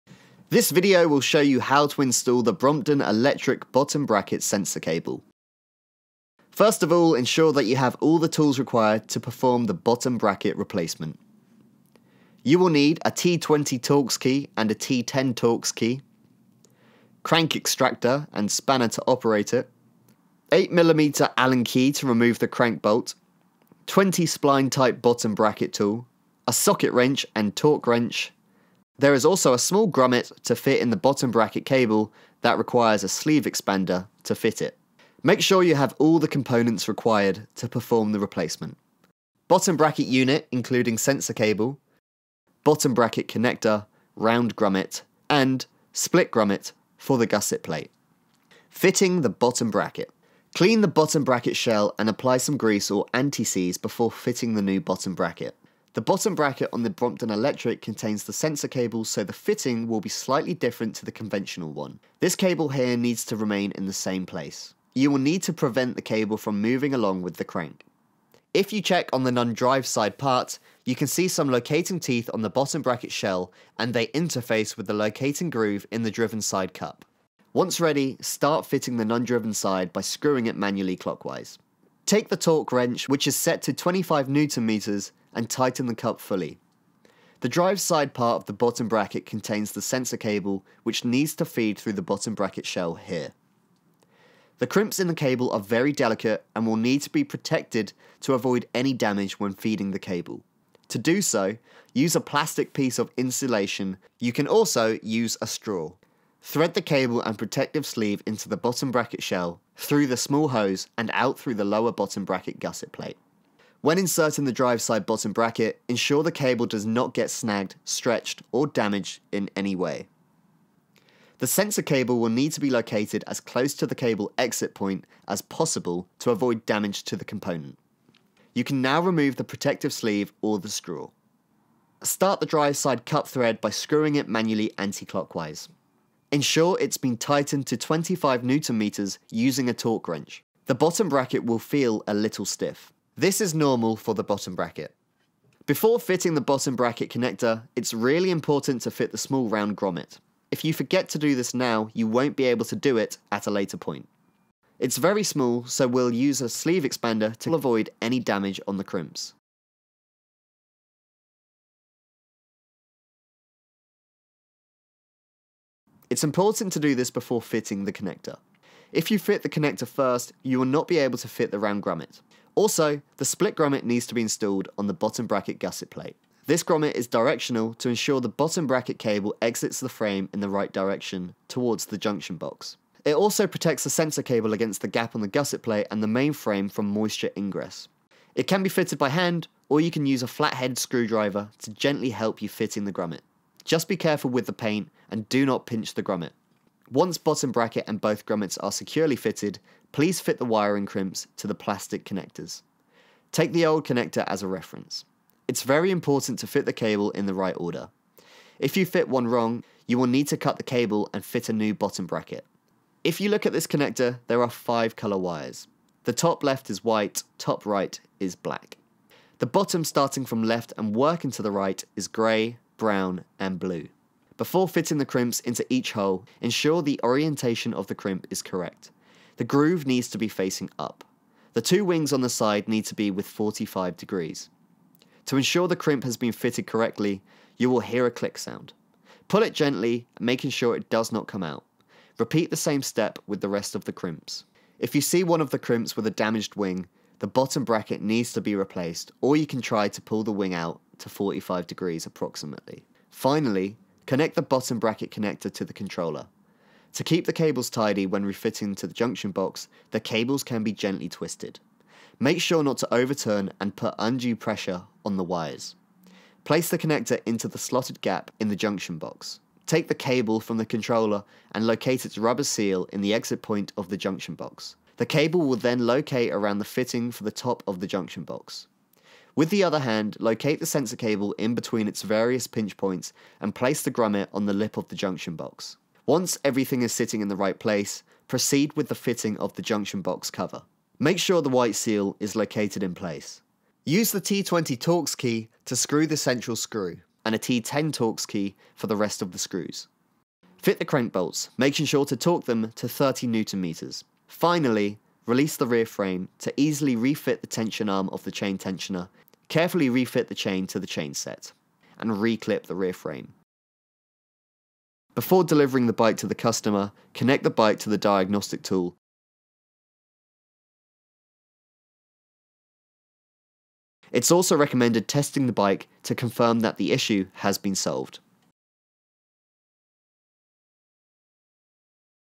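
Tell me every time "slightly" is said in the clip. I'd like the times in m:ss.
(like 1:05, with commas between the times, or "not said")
1:00.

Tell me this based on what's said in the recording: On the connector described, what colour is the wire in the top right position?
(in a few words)
Black.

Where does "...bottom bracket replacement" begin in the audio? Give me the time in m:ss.
0:09.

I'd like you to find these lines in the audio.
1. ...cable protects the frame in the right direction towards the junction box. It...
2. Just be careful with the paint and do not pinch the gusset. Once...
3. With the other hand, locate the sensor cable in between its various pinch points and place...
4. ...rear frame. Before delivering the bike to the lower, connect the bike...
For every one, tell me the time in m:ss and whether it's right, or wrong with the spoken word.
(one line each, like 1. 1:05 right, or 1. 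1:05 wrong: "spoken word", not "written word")
1. 2:58 wrong: "exits", not "protects"
2. 3:13 wrong: "grommet", not "gusset"
3. 4:39 right
4. 5:12 wrong: "customer", not "lower".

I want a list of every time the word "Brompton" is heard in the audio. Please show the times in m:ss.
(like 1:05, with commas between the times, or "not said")
0:02, 0:56.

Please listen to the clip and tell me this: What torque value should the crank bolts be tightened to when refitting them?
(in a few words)
30 newton meters.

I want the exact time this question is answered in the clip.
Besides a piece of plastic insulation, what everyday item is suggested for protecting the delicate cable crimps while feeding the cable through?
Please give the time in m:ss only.
1:45.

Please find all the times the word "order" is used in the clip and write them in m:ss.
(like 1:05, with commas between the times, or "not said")
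3:27.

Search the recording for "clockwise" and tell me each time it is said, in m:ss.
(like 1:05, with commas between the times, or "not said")
1:20, 2:14.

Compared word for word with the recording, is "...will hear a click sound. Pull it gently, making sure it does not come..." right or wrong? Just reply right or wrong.
right.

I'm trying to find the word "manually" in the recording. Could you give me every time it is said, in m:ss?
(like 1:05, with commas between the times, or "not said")
1:20, 2:14.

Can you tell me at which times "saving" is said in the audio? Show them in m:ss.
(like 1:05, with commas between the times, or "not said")
not said.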